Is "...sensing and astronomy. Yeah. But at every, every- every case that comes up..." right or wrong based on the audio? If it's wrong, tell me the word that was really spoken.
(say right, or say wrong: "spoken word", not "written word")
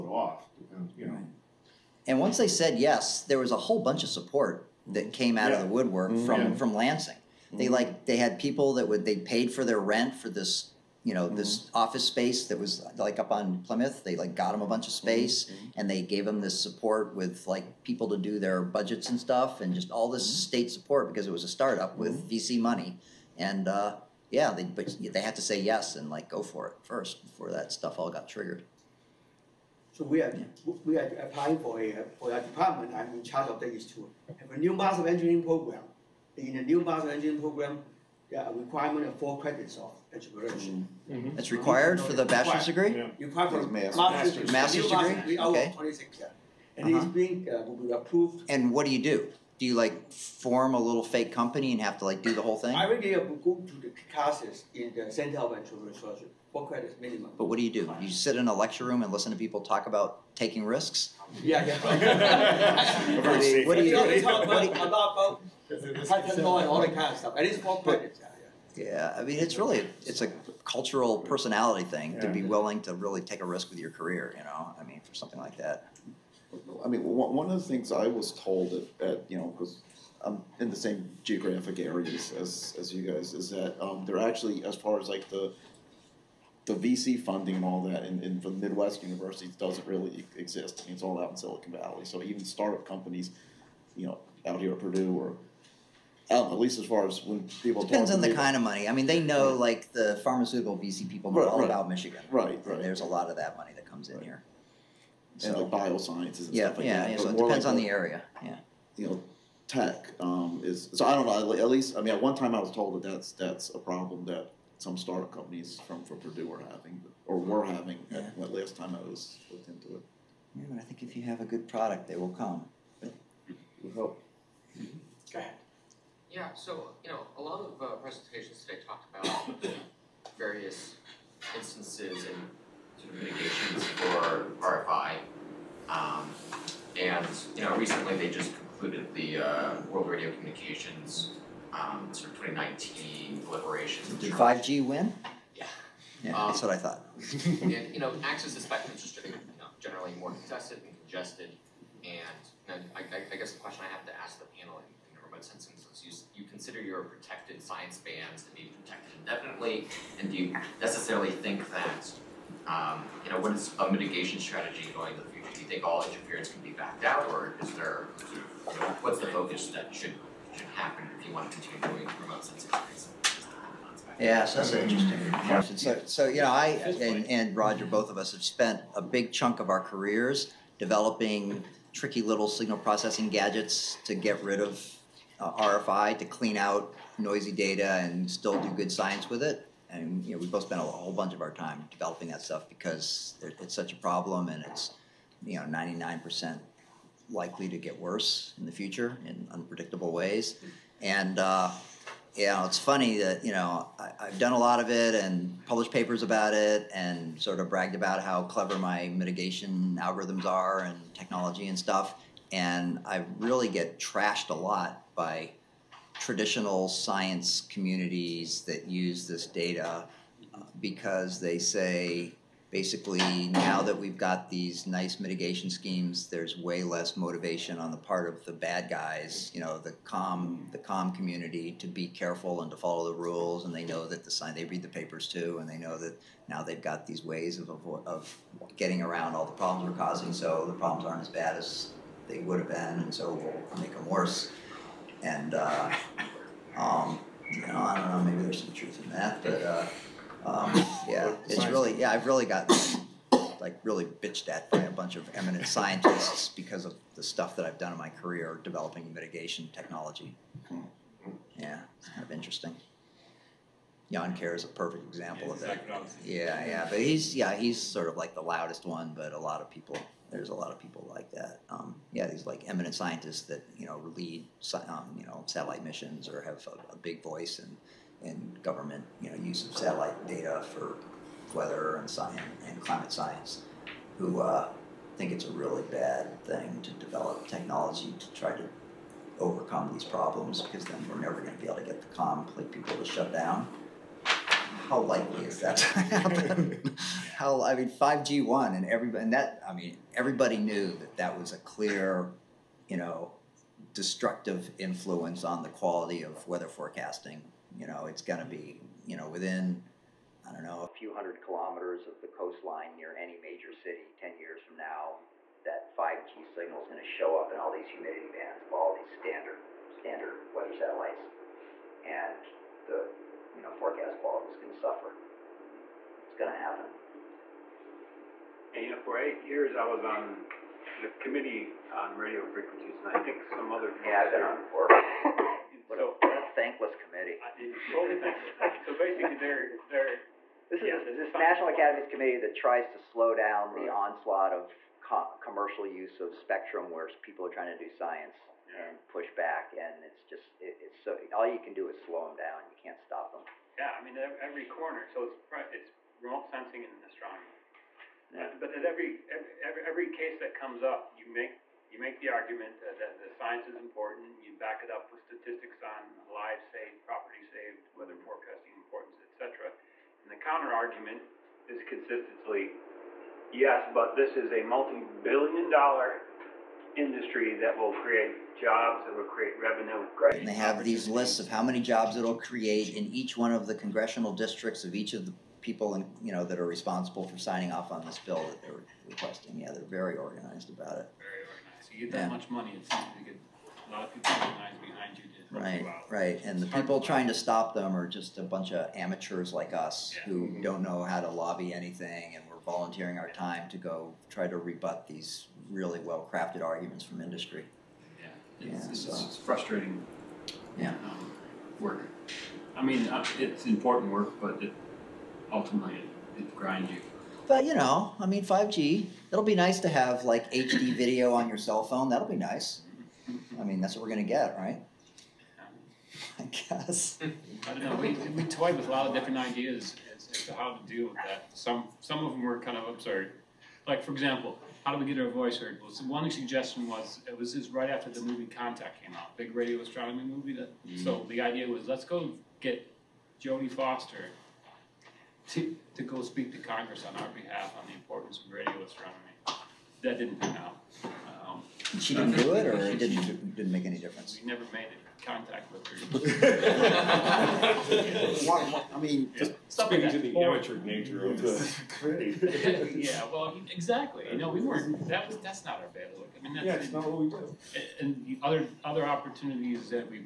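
right.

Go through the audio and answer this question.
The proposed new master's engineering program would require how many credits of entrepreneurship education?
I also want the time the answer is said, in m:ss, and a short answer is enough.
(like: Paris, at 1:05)
4, at 0:39.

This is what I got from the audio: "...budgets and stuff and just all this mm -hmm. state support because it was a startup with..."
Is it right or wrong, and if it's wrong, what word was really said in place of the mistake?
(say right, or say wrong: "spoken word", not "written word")
right.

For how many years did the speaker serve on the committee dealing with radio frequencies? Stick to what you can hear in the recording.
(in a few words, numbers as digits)
8.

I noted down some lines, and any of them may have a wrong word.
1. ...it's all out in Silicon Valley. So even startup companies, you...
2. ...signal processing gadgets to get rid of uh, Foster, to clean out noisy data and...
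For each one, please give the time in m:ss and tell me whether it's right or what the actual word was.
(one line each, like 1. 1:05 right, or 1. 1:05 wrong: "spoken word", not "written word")
1. 1:30 right
2. 3:02 wrong: "RFI", not "Foster".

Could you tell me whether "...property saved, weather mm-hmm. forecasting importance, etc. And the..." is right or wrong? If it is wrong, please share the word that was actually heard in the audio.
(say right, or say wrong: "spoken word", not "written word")
right.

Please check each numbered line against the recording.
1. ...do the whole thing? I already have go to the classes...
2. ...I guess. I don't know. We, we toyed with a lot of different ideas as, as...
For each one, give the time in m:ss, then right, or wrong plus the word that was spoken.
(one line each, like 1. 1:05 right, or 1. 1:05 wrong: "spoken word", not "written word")
1. 0:52 right
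2. 7:06 right.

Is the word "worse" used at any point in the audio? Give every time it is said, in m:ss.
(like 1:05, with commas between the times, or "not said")
3:17, 4:04.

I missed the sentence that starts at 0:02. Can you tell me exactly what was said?
And once they said yes, there was a whole bunch of support that came out yeah.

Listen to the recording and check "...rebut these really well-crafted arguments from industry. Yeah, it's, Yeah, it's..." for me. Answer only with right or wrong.
right.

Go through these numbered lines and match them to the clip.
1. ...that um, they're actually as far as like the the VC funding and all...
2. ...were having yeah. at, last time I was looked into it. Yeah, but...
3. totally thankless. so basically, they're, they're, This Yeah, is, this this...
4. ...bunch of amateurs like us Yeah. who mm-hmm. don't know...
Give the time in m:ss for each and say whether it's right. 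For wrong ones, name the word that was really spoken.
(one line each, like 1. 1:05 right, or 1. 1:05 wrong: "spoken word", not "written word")
1. 1:23 right
2. 1:57 right
3. 5:37 right
4. 6:38 right.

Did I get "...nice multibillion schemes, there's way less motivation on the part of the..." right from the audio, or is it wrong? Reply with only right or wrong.
wrong.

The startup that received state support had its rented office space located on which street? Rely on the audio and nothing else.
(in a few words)
Plymouth.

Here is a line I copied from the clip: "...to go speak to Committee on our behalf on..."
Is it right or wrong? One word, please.
wrong.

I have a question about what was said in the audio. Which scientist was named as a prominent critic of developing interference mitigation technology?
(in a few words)
Yann Kerr.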